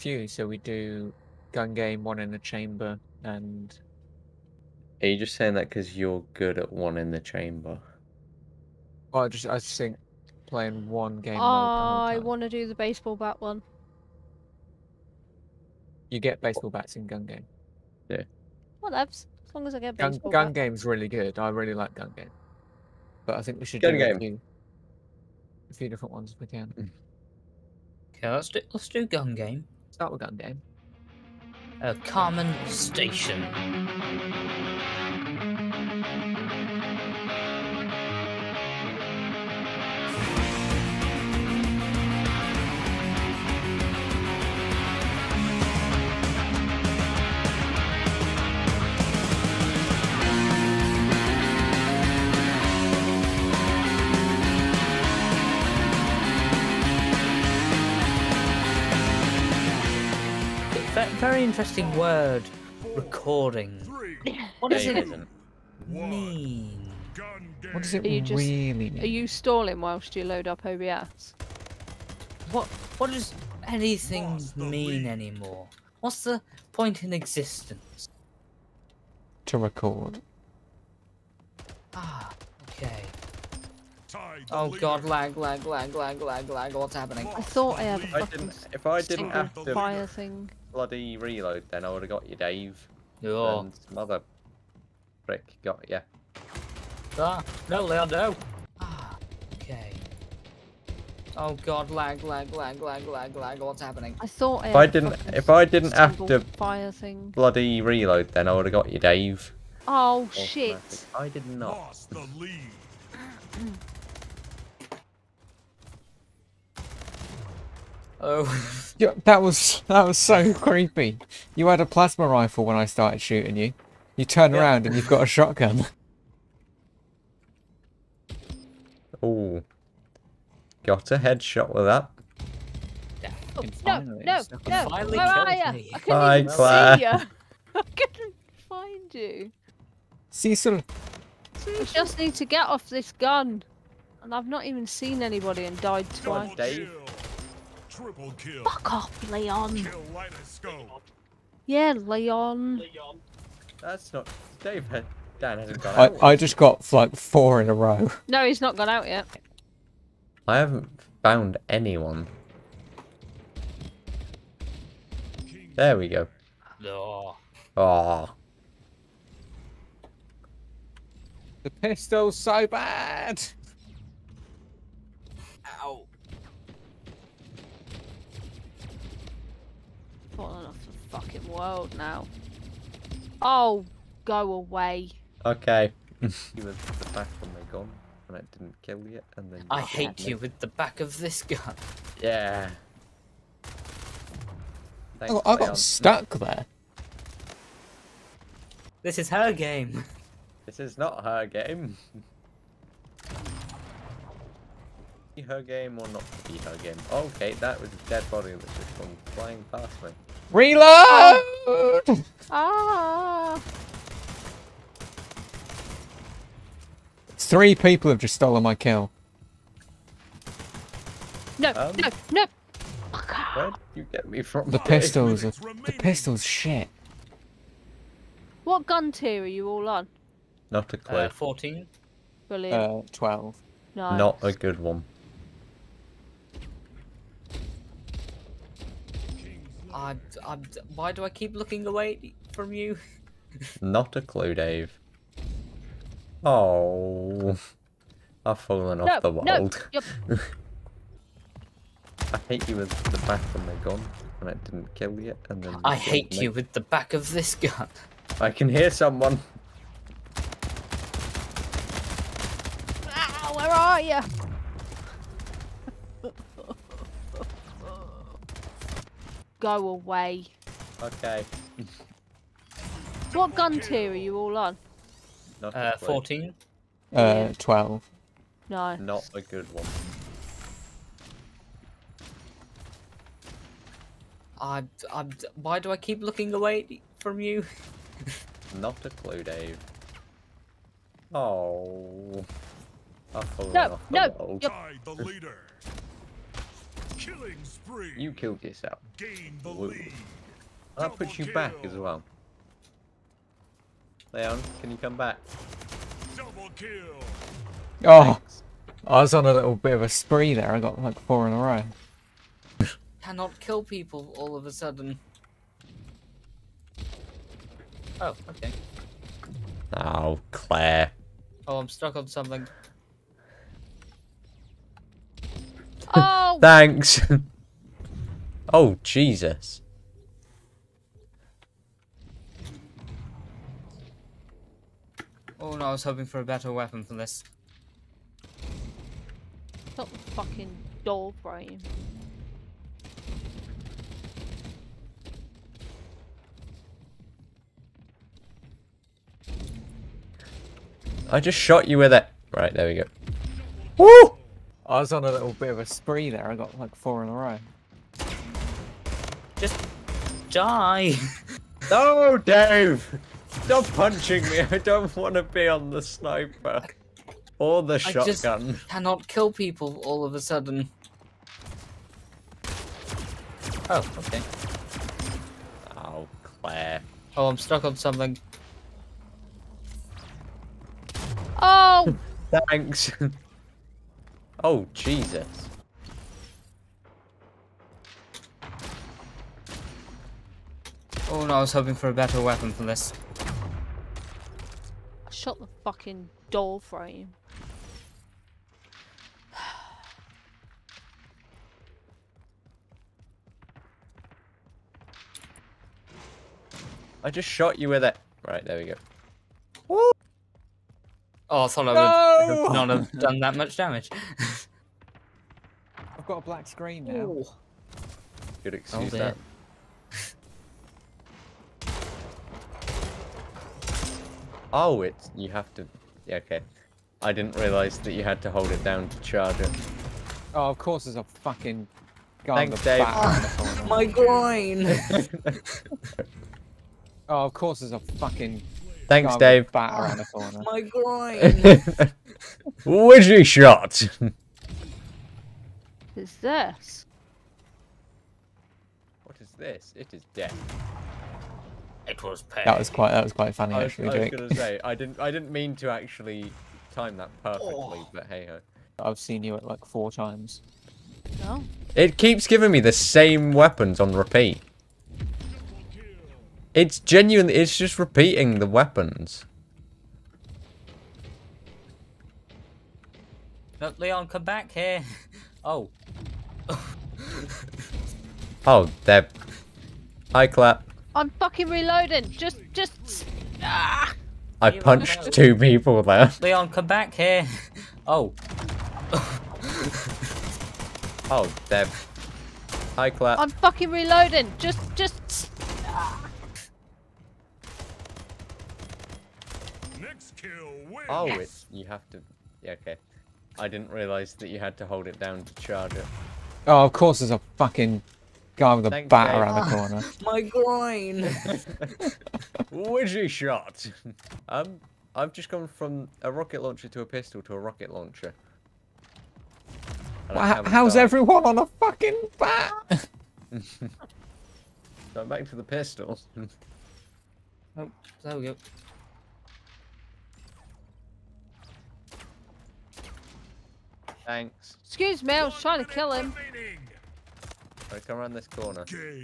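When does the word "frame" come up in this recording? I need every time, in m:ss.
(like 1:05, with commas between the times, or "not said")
6:36.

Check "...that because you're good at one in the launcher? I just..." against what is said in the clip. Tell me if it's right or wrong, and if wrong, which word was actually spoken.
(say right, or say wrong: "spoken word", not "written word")
wrong: "chamber", not "launcher".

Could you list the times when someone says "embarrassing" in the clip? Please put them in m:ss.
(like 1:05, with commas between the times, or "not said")
not said.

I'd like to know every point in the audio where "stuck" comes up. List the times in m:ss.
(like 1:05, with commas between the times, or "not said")
3:15, 5:21, 6:17.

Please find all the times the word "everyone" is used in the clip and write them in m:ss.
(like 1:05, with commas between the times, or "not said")
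8:41.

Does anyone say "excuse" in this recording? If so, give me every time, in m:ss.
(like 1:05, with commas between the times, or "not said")
6:58, 8:54.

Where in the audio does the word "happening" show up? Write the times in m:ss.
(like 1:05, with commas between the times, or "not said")
1:26, 1:43.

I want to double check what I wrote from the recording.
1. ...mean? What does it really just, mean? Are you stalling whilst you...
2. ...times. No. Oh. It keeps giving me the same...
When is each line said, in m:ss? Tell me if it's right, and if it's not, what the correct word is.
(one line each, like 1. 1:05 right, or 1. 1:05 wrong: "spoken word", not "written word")
1. 1:05 right
2. 7:40 right.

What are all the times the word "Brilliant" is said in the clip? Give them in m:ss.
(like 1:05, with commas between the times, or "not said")
3:52.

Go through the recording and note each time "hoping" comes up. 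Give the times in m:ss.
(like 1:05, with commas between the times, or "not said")
5:36, 6:31.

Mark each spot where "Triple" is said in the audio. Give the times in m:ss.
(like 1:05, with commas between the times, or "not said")
2:27.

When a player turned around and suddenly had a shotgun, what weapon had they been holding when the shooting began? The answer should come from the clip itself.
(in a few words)
plasma rifle.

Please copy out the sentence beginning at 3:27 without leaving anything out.
Okay, that was a dead body that just gone flying past me.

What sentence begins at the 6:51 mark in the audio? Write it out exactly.
I would not have done that much damage.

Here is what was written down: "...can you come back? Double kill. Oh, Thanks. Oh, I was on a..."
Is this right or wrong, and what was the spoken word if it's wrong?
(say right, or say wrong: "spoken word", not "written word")
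right.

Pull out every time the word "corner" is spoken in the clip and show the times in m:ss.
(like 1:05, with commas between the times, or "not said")
7:20, 8:29, 8:58.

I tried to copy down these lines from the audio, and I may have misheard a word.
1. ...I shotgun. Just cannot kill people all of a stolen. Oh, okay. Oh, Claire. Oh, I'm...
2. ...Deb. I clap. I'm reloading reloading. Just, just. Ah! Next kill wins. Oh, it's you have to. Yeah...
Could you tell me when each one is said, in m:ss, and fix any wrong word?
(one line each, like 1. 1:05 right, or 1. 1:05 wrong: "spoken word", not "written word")
1. 6:07 wrong: "sudden", not "stolen"
2. 8:11 wrong: "fucking", not "reloading".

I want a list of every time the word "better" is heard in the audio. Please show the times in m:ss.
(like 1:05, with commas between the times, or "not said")
5:36, 6:32.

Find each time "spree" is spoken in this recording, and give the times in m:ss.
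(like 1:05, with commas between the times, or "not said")
4:57, 5:10, 5:55.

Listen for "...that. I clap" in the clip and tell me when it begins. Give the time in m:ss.
7:59.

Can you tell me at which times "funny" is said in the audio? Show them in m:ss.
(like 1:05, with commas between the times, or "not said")
7:33.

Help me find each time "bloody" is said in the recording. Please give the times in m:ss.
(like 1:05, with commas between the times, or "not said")
1:30, 1:47.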